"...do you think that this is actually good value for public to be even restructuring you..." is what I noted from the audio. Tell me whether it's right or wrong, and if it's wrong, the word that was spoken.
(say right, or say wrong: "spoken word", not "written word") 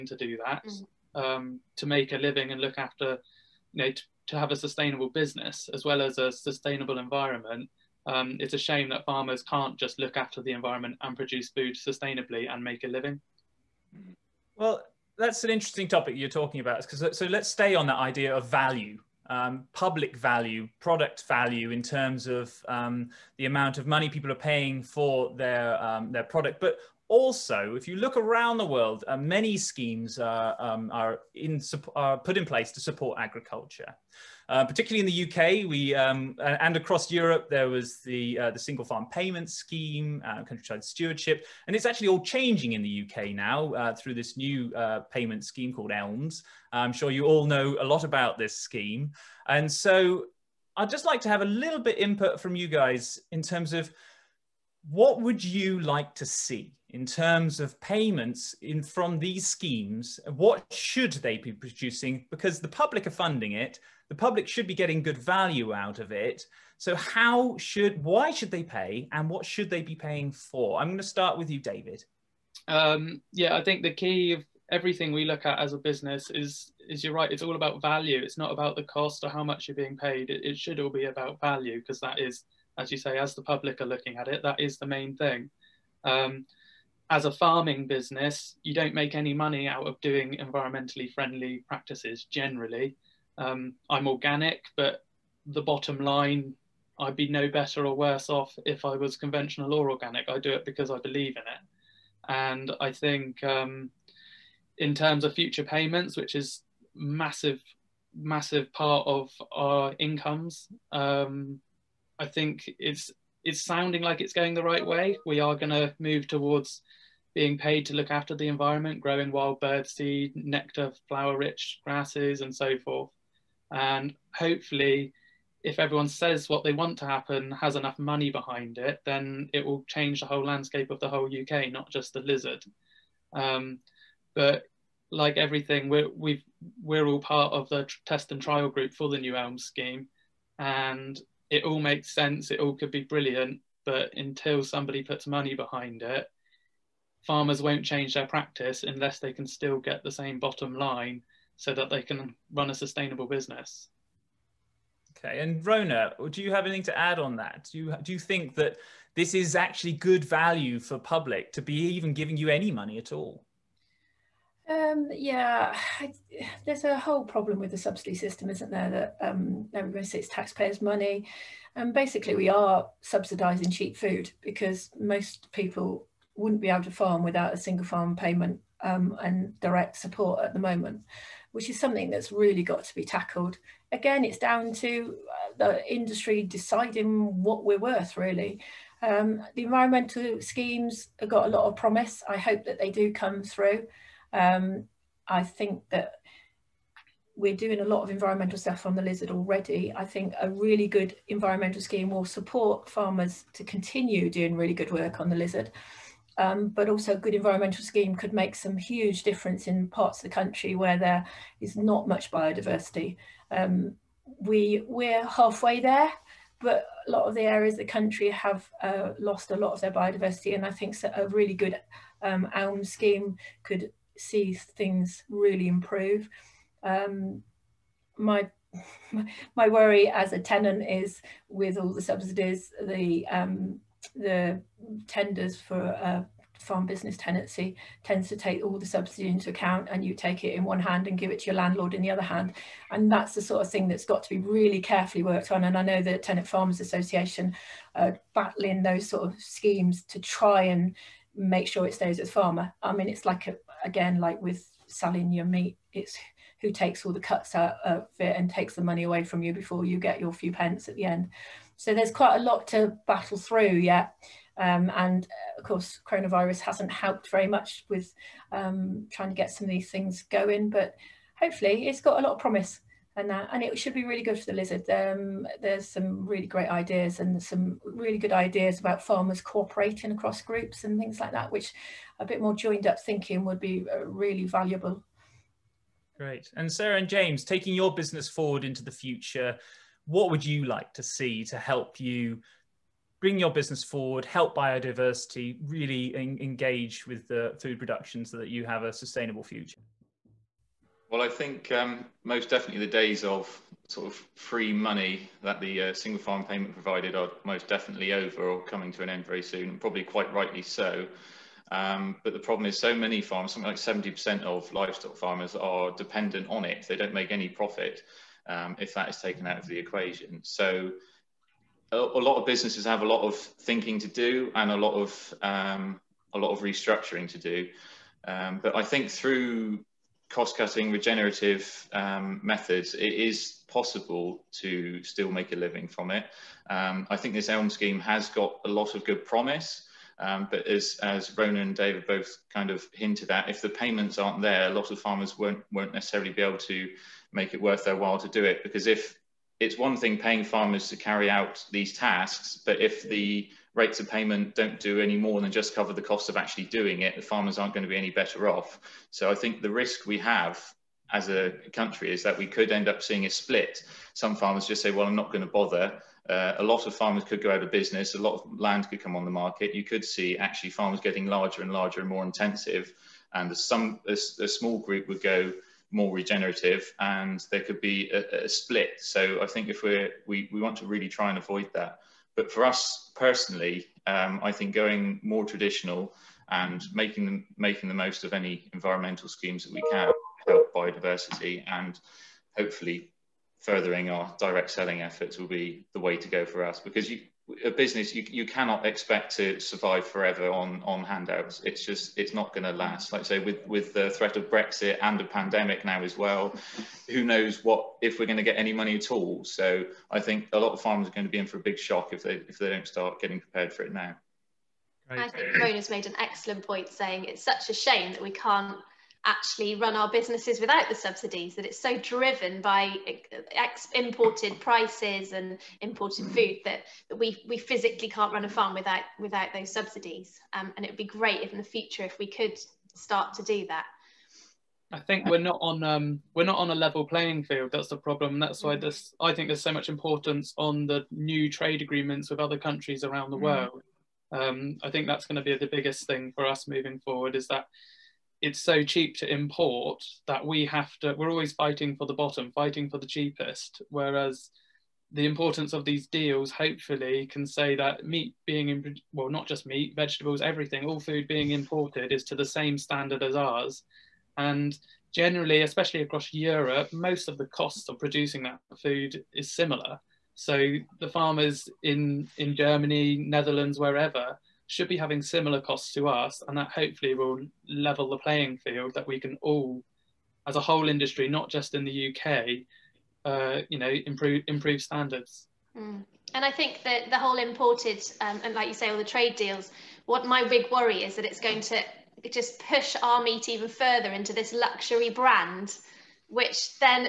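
wrong: "giving", not "restructuring".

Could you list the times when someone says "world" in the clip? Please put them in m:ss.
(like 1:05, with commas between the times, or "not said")
0:28, 7:23.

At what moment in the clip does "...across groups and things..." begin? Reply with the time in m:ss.
4:40.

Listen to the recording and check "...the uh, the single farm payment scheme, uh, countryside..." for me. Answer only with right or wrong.
right.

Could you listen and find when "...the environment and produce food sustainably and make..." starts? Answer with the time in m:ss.
0:10.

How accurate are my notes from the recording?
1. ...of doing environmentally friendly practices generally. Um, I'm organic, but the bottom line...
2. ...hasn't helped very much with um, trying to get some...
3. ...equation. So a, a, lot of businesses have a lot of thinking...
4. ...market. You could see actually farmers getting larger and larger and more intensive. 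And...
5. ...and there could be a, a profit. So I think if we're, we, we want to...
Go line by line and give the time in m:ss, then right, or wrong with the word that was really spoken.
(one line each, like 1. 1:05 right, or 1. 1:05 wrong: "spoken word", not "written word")
1. 1:29 right
2. 4:26 right
3. 5:19 right
4. 6:09 right
5. 6:16 wrong: "split", not "profit".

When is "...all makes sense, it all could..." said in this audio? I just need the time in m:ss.
2:21.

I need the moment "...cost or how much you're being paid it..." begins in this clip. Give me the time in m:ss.
1:18.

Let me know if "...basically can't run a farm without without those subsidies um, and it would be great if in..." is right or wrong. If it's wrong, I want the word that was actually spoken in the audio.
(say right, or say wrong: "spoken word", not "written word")
wrong: "physically", not "basically".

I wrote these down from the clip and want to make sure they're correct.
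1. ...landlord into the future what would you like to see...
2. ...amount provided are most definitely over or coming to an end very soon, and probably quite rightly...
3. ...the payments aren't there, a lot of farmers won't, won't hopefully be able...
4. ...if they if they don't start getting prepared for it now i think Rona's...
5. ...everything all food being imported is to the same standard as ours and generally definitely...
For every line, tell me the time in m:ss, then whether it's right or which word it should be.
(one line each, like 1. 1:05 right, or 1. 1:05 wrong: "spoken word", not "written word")
1. 4:48 wrong: "forward", not "landlord"
2. 5:06 wrong: "payment", not "amount"
3. 5:43 wrong: "necessarily", not "hopefully"
4. 6:52 right
5. 7:40 wrong: "especially", not "definitely".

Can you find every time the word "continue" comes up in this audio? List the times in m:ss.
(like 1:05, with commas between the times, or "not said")
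3:23.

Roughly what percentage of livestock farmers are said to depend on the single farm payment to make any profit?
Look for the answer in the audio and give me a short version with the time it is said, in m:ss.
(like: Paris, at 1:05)
70%, at 5:13.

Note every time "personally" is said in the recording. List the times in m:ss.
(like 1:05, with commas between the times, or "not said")
6:23.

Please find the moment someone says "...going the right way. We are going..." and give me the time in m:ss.
1:54.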